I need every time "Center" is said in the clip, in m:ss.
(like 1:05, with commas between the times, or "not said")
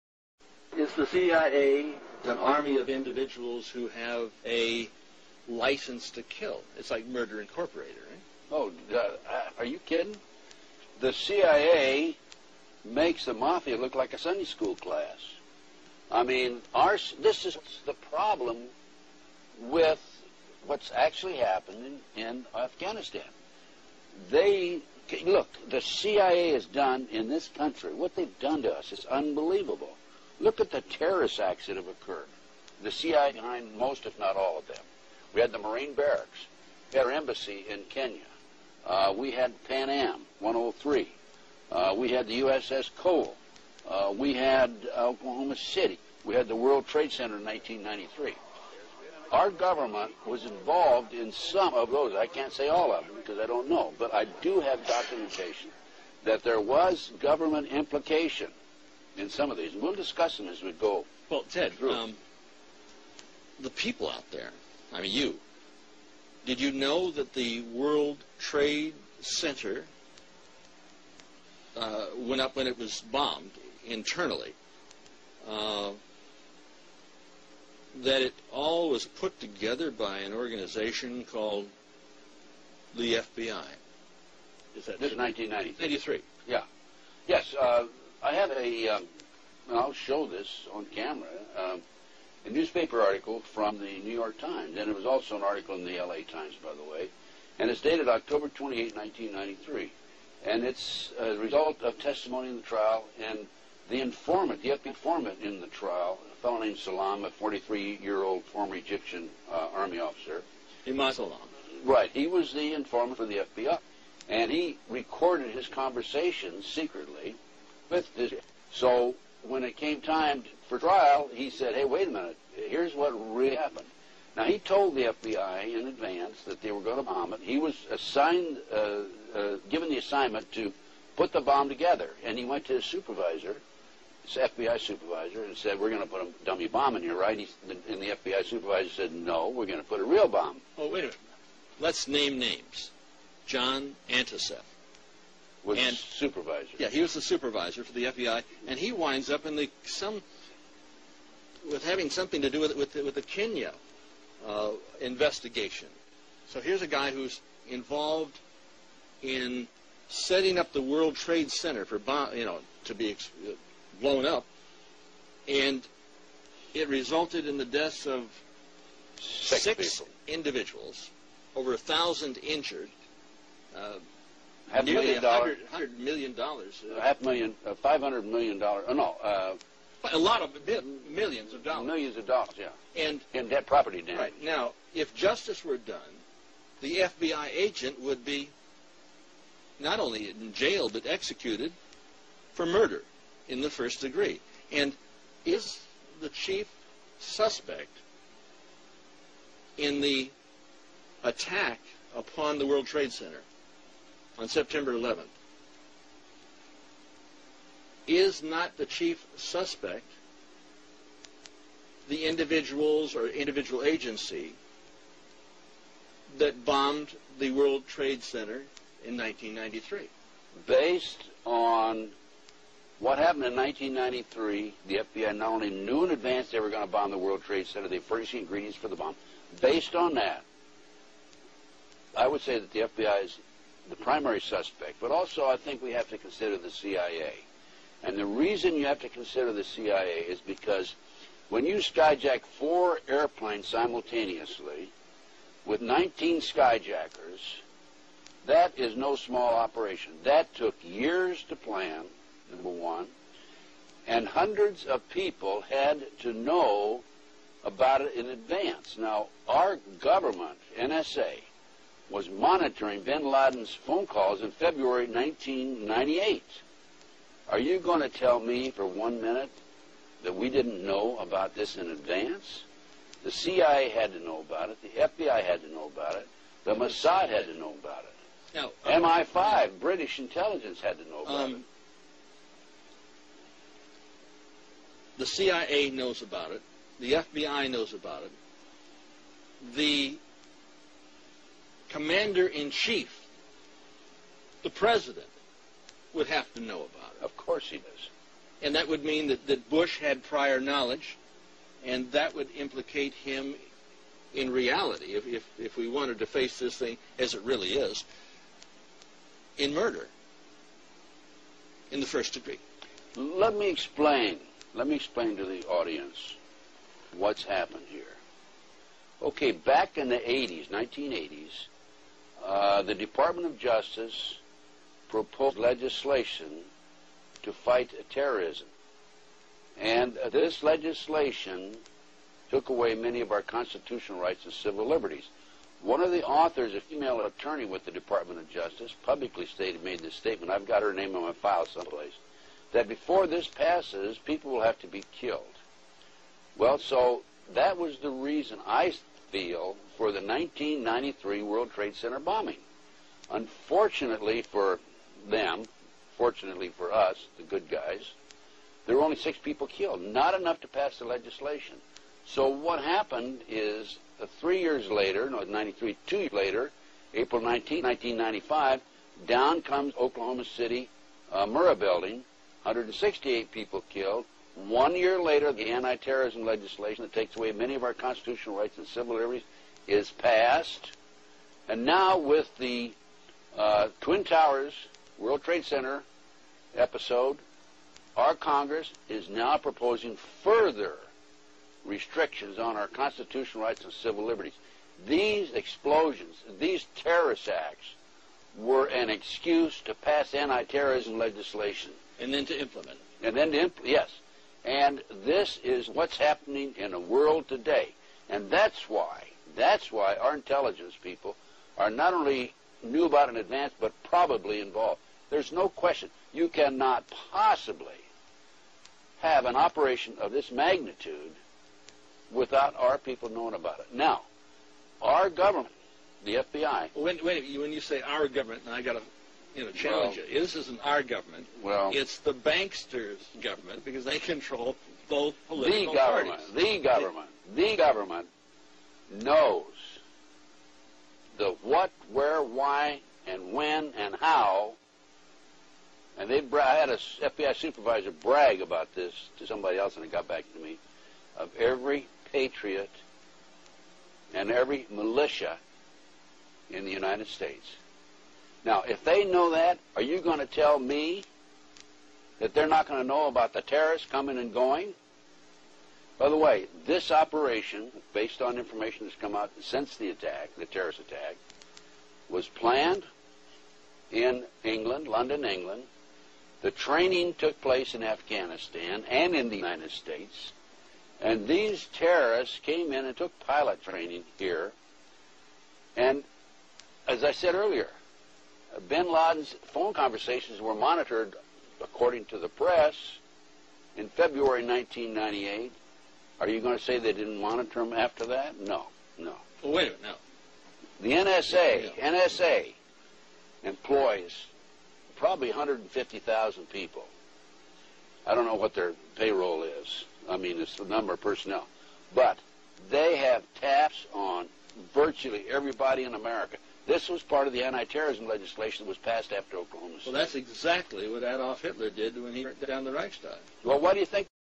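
0:47, 1:09, 2:41, 3:23, 3:38, 3:47, 5:51, 6:25.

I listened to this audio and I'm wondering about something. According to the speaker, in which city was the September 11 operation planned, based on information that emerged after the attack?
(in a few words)
London.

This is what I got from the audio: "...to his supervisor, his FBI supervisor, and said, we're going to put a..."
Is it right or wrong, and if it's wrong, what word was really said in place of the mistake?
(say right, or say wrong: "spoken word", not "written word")
right.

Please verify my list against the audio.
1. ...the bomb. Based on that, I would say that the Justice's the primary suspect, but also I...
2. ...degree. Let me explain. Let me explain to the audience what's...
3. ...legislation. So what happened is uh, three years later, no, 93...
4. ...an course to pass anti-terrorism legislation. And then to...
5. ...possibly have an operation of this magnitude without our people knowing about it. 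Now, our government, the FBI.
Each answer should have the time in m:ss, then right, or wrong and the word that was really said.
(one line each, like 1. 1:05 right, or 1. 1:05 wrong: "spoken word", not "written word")
1. 3:48 wrong: "FBI", not "Justice"
2. 5:12 right
3. 6:01 right
4. 6:38 wrong: "excuse", not "course"
5. 6:57 right.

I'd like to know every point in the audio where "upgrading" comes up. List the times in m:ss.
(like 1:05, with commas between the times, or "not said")
not said.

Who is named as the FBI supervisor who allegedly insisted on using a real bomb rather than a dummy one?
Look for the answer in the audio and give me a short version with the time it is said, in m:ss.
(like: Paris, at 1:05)
John Anticev, at 2:23.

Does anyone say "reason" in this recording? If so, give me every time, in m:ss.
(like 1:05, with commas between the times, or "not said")
3:58, 5:48.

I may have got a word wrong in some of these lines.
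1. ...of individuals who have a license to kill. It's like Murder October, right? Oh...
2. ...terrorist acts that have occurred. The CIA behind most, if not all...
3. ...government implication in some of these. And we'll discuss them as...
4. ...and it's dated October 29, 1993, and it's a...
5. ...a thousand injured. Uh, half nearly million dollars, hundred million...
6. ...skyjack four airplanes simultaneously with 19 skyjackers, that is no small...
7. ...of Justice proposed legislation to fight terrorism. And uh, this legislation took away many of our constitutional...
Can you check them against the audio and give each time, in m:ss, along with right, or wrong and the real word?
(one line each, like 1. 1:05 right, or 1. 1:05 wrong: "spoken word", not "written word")
1. 0:02 wrong: "Incorporated", not "October"
2. 0:30 right
3. 0:57 right
4. 1:37 wrong: "28", not "29"
5. 2:51 right
6. 4:01 right
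7. 5:23 right.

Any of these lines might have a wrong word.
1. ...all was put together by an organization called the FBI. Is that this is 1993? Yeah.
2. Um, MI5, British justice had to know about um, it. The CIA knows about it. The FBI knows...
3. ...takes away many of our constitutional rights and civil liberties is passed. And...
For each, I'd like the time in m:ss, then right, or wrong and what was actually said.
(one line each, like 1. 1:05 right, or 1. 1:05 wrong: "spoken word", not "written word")
1. 1:18 right
2. 4:38 wrong: "intelligence", not "justice"
3. 6:17 right.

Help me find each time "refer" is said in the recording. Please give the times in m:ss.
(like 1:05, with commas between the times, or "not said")
not said.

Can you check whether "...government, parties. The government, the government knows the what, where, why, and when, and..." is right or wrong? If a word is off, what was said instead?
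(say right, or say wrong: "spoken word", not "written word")
right.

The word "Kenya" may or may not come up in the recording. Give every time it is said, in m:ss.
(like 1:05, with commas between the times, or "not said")
0:37, 2:33.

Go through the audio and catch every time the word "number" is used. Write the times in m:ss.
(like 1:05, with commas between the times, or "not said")
4:12, 8:30.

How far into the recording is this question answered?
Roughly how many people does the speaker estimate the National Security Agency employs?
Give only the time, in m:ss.
8:25.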